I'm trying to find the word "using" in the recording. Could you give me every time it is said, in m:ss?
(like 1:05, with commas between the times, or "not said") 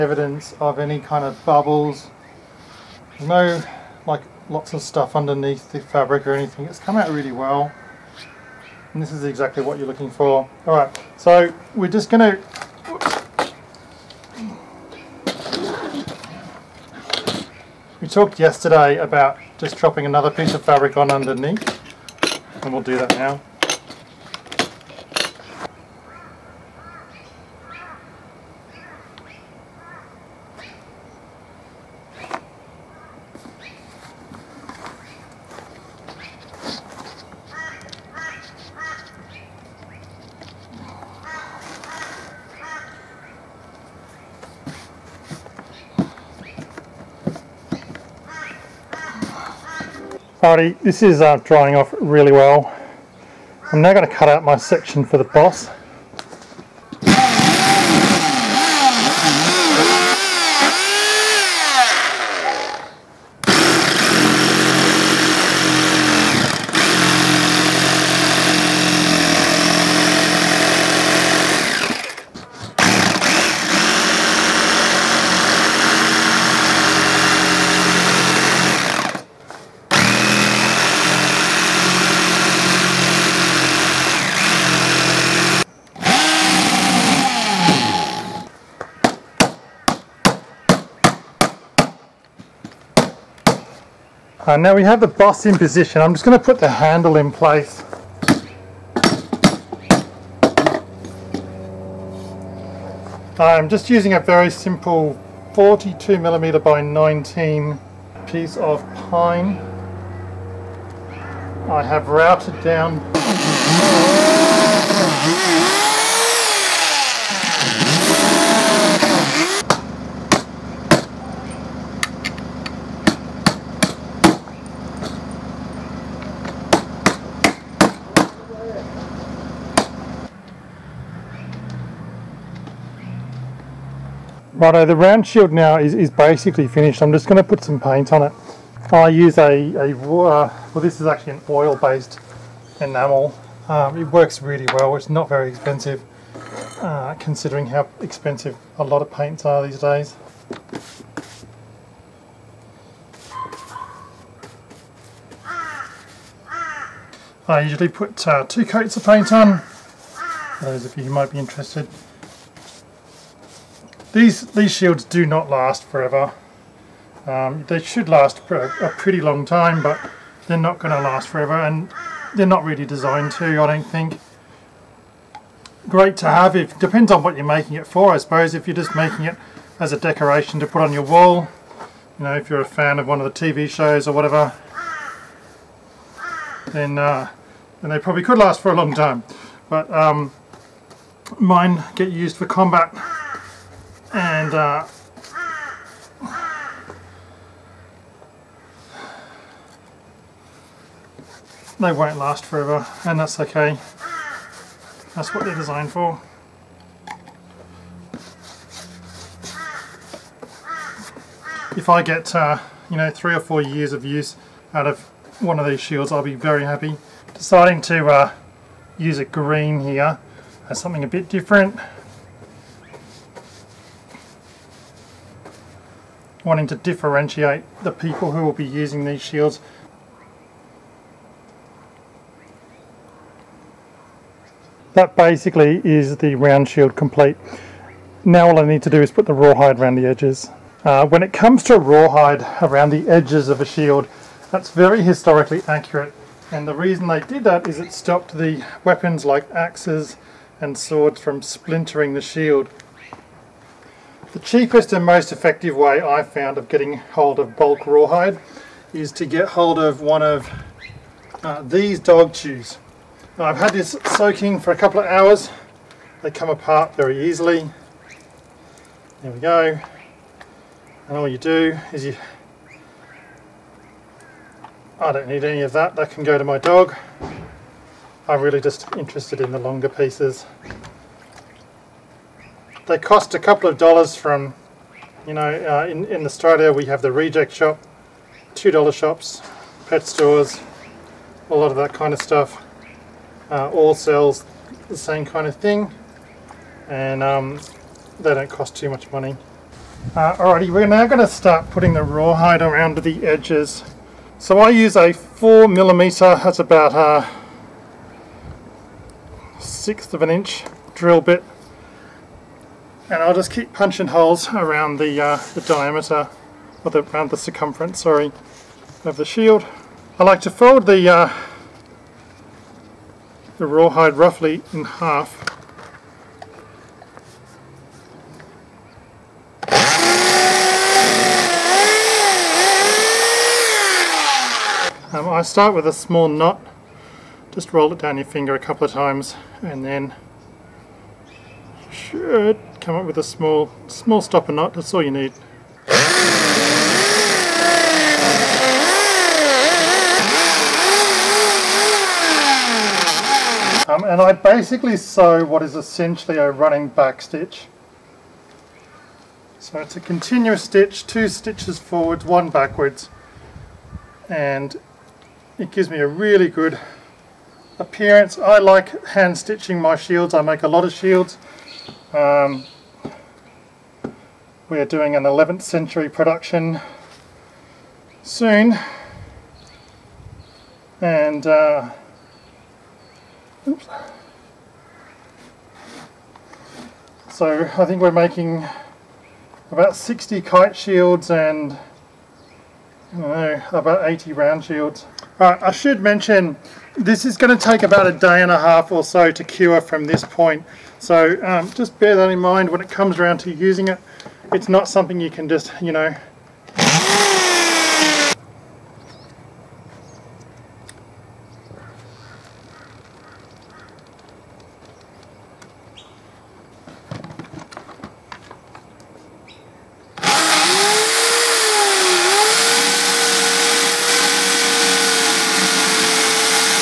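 1:43, 3:48, 6:43.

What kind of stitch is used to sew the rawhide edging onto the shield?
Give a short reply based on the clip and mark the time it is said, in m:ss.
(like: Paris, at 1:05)
running back stitch, at 5:56.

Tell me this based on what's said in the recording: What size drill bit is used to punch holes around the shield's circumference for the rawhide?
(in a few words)
4 mm.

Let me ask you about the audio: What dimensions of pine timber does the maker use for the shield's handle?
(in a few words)
42 mm by 19.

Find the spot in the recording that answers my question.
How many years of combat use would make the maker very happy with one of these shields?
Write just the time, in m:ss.
3:33.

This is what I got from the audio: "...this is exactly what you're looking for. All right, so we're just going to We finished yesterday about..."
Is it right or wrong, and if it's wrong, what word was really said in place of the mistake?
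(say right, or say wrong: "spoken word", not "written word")
wrong: "talked", not "finished".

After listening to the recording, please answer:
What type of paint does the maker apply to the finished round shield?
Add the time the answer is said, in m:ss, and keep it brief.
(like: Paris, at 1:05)
oil-based enamel, at 2:21.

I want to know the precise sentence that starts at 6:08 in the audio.
I like hand stitching my shields, I make a lot of shields.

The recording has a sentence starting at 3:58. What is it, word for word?
Now all I need to do is put the rawhide around the edges.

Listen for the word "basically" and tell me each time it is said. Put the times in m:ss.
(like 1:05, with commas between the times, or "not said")
2:16, 3:55, 5:54.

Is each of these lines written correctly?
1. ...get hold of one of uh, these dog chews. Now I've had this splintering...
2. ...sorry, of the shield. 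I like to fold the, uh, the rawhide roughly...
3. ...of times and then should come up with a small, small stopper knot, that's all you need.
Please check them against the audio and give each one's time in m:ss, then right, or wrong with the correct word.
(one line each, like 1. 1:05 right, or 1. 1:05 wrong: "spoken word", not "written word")
1. 4:19 wrong: "soaking", not "splintering"
2. 5:18 right
3. 5:38 right.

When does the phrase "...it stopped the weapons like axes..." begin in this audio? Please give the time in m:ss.
4:07.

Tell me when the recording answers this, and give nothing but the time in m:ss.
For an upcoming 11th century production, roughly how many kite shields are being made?
6:29.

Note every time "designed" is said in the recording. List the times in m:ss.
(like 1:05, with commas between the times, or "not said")
2:52, 3:25.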